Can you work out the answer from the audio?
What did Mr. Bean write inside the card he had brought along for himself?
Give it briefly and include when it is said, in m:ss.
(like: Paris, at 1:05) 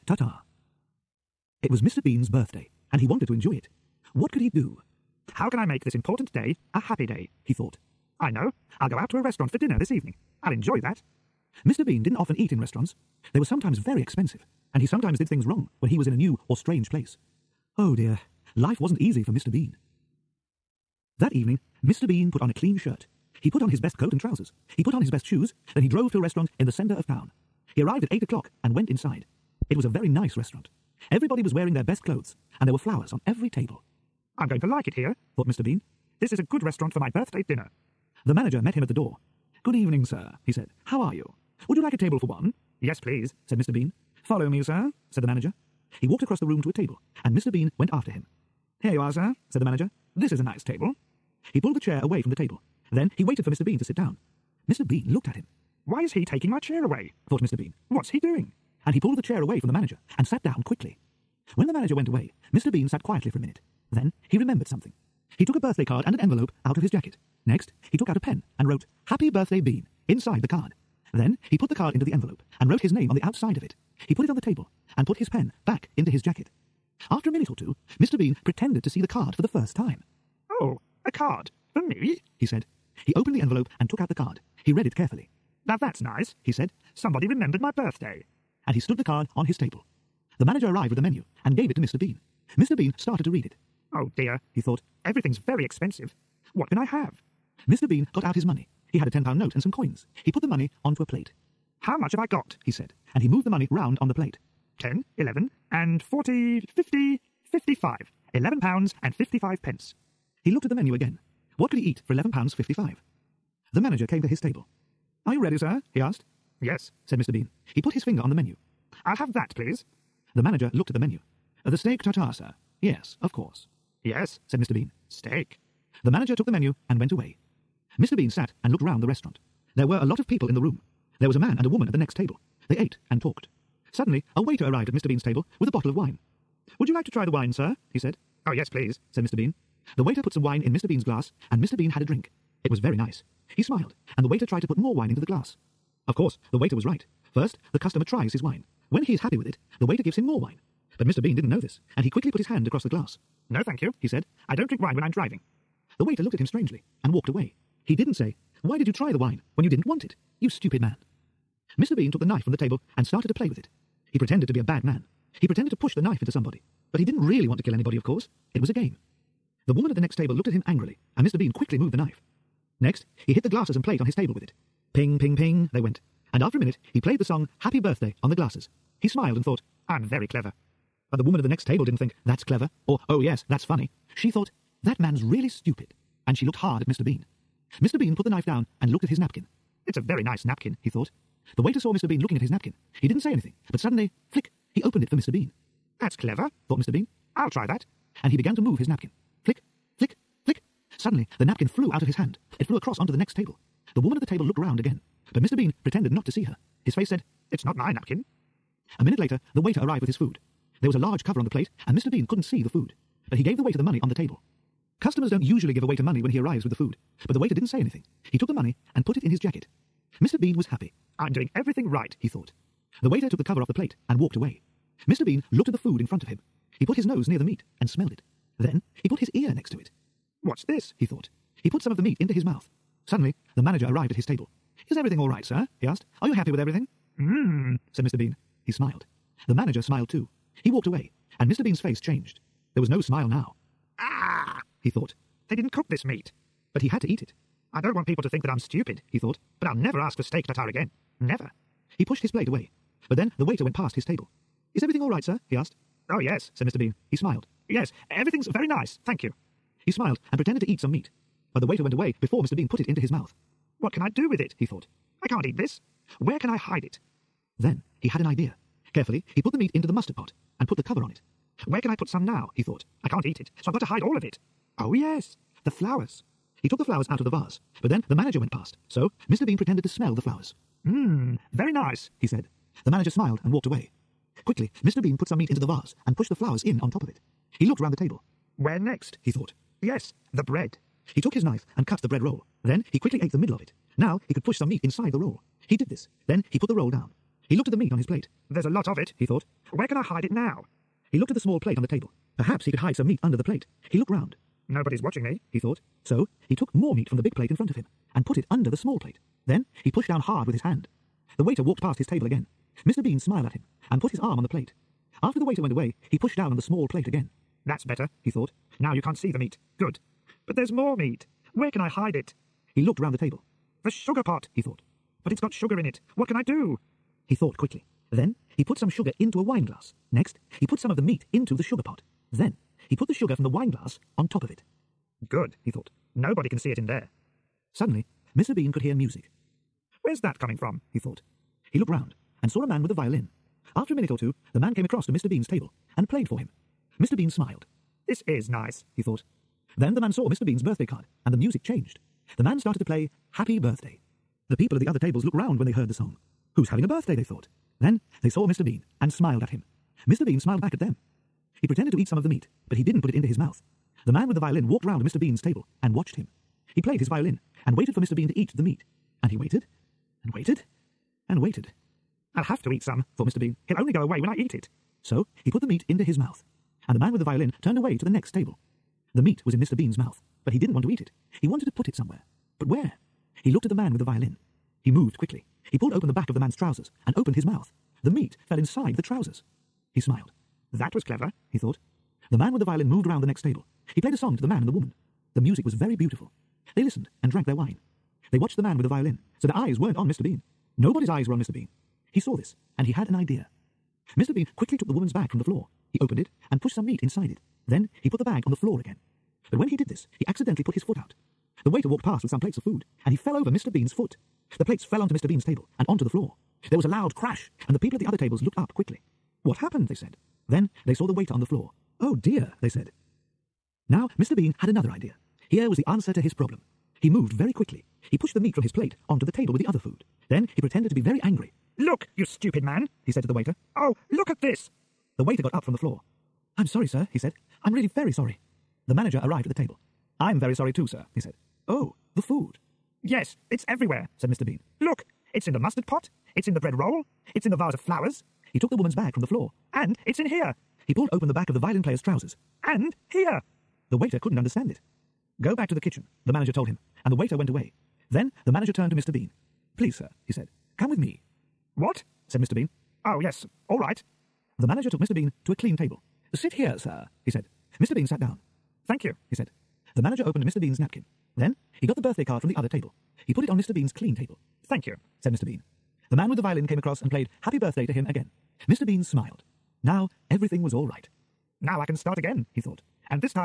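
Happy Birthday Bean, at 1:09.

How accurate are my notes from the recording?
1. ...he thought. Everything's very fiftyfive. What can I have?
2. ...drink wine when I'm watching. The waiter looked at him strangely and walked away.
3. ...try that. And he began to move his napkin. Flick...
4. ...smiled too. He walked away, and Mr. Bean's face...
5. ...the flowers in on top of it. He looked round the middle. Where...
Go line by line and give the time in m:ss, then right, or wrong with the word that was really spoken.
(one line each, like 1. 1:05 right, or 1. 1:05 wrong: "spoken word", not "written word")
1. 1:34 wrong: "expensive", not "fiftyfive"
2. 2:34 wrong: "driving", not "watching"
3. 3:17 right
4. 3:59 right
5. 4:46 wrong: "table", not "middle".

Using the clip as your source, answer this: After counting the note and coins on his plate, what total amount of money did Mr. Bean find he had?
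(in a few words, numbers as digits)
£11.55.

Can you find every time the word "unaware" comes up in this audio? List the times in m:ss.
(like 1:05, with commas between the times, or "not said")
not said.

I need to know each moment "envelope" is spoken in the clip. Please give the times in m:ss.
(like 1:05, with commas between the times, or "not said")
1:06, 1:12, 1:23.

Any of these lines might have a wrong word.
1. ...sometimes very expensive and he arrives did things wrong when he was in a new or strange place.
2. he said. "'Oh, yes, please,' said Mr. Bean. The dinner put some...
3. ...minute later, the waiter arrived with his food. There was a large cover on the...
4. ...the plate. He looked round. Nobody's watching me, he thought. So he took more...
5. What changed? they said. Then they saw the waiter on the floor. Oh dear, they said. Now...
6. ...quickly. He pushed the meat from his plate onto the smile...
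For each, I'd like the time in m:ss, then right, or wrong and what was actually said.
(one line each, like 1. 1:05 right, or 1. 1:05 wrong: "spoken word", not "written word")
1. 0:13 wrong: "sometimes", not "arrives"
2. 2:17 wrong: "waiter", not "dinner"
3. 3:29 right
4. 5:03 right
5. 6:59 wrong: "happened", not "changed"
6. 7:07 wrong: "table", not "smile".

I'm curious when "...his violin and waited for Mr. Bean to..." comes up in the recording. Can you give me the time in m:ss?
6:06.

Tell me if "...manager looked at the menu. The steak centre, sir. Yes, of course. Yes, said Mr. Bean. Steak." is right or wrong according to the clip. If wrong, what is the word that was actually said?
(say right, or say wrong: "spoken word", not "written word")
wrong: "tartare", not "centre".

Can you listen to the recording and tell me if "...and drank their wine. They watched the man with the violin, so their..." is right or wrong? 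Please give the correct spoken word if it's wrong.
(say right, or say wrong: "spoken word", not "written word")
right.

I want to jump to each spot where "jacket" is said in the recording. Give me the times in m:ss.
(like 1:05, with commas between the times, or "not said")
1:06, 1:16, 3:39.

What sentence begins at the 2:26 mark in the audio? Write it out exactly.
Of course, the waiter was right.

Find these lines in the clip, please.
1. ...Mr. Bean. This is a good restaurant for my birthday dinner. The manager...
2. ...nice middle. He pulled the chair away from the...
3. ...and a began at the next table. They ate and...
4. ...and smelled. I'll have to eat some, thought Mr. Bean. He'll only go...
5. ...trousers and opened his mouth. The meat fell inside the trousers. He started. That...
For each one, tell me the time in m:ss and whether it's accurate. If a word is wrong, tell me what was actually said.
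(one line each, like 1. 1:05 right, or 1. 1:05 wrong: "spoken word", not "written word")
1. 0:35 right
2. 0:50 wrong: "table", not "middle"
3. 2:11 wrong: "woman", not "began"
4. 6:11 wrong: "waited", not "smelled"
5. 6:26 wrong: "smiled", not "started".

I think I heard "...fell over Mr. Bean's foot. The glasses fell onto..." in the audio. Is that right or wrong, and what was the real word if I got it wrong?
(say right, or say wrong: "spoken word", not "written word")
wrong: "plates", not "glasses".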